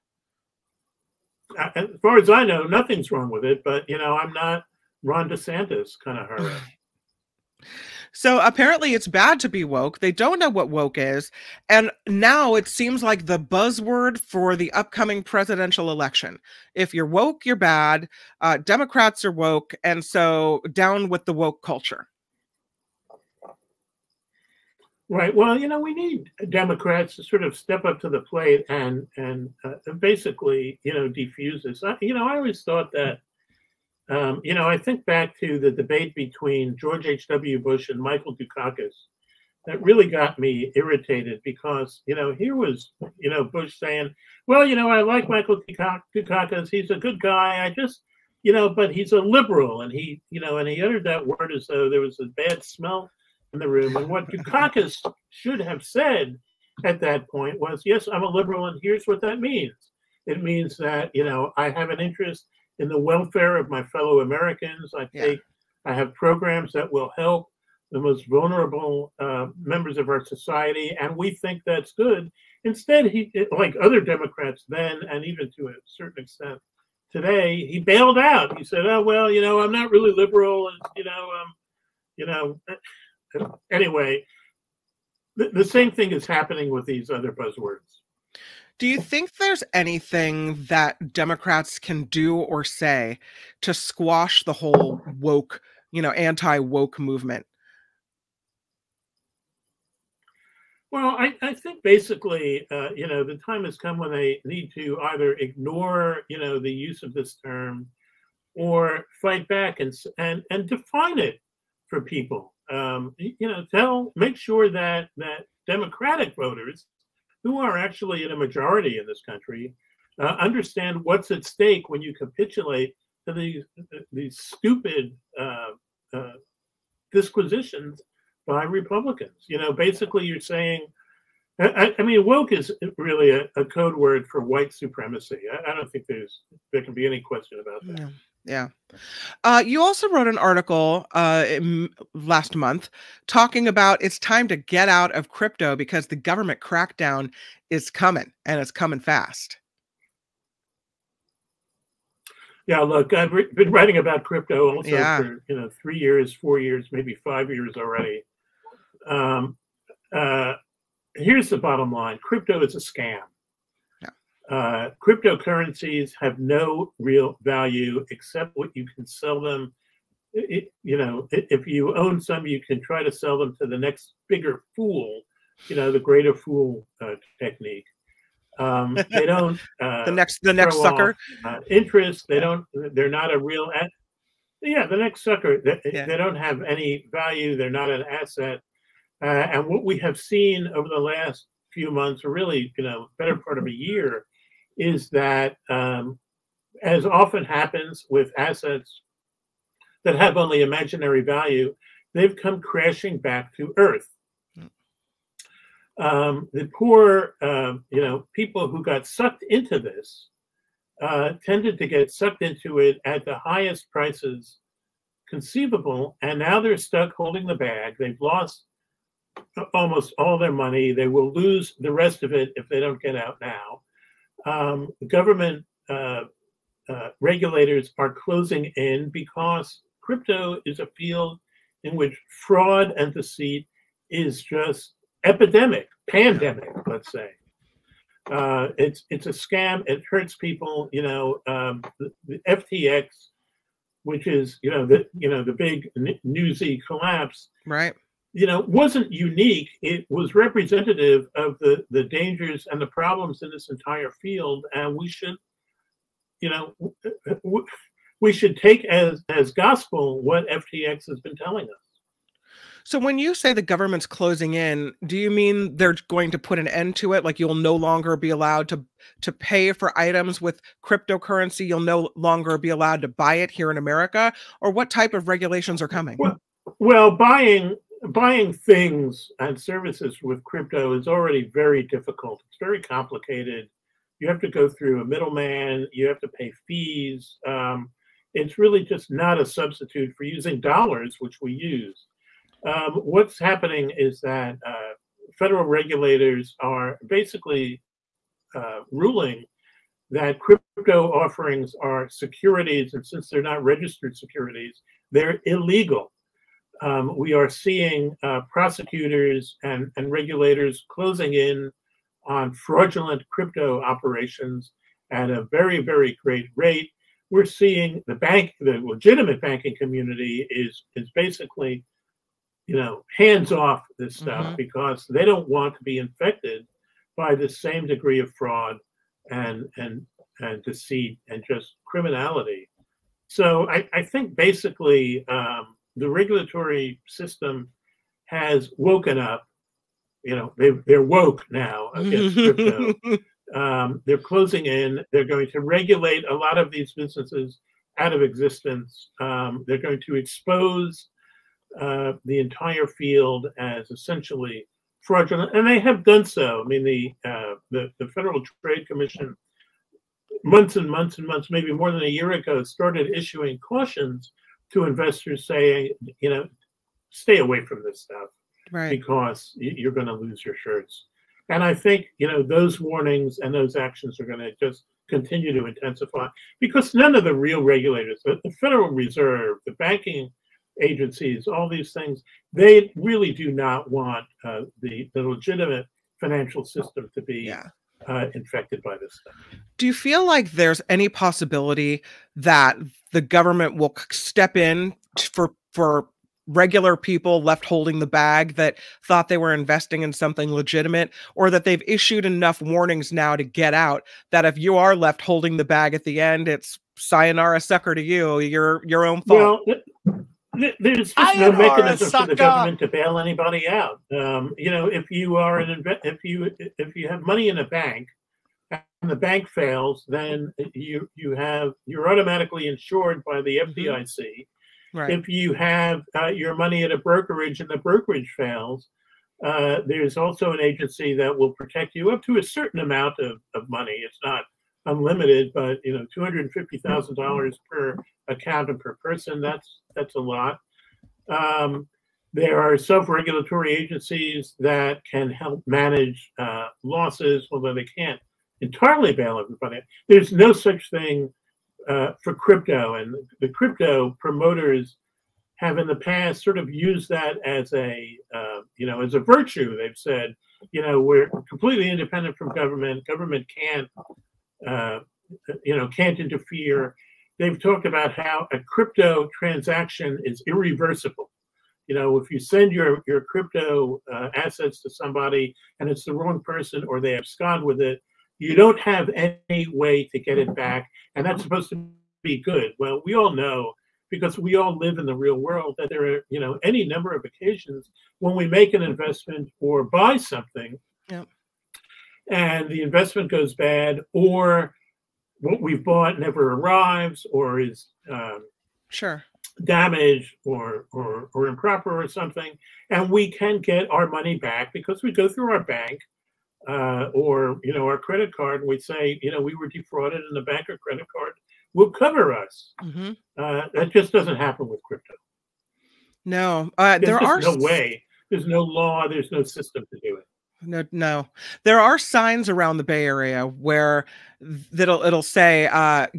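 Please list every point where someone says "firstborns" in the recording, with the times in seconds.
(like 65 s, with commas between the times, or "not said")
not said.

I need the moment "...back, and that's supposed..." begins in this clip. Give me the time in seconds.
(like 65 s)
480 s.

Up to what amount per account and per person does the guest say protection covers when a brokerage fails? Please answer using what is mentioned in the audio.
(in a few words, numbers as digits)
$250,000.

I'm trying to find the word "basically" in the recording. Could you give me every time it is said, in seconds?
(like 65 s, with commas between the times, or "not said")
29 s, 101 s, 129 s, 297 s, 321 s, 334 s.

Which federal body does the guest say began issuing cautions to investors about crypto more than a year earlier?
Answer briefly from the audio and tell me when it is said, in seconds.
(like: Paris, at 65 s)
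Federal Trade Commission, at 358 s.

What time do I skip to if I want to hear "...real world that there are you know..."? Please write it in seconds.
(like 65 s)
485 s.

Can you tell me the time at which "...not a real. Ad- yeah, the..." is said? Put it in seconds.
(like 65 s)
183 s.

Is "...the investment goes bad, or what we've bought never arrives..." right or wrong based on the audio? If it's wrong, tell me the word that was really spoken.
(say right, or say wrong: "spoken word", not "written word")
right.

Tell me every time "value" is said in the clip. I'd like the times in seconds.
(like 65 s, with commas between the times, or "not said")
167 s, 187 s, 201 s.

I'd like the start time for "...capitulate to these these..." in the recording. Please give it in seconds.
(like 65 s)
122 s.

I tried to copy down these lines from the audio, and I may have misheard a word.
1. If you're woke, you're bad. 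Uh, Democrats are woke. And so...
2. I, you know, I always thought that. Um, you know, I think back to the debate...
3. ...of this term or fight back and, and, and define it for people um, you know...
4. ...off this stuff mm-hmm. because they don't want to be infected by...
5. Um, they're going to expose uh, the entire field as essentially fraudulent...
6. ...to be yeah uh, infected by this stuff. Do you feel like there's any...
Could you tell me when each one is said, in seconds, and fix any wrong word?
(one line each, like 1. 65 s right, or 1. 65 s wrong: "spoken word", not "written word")
1. 16 s right
2. 31 s right
3. 107 s right
4. 323 s right
5. 349 s right
6. 387 s right.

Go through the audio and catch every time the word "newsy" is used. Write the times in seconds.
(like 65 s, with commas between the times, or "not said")
246 s.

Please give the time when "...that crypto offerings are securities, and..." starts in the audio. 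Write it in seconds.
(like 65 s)
300 s.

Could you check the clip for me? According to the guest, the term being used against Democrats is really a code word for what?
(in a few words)
White supremacy.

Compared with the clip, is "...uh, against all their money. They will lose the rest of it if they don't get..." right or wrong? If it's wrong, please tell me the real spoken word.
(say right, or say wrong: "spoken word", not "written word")
wrong: "almost", not "against".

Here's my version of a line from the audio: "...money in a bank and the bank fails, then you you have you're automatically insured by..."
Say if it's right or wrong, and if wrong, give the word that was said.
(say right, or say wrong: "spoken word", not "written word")
right.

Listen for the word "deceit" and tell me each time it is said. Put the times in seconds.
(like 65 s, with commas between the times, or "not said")
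233 s, 330 s.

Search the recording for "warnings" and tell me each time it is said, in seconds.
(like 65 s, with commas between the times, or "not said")
372 s, 402 s.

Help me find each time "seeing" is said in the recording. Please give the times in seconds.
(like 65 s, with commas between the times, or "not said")
307 s, 317 s.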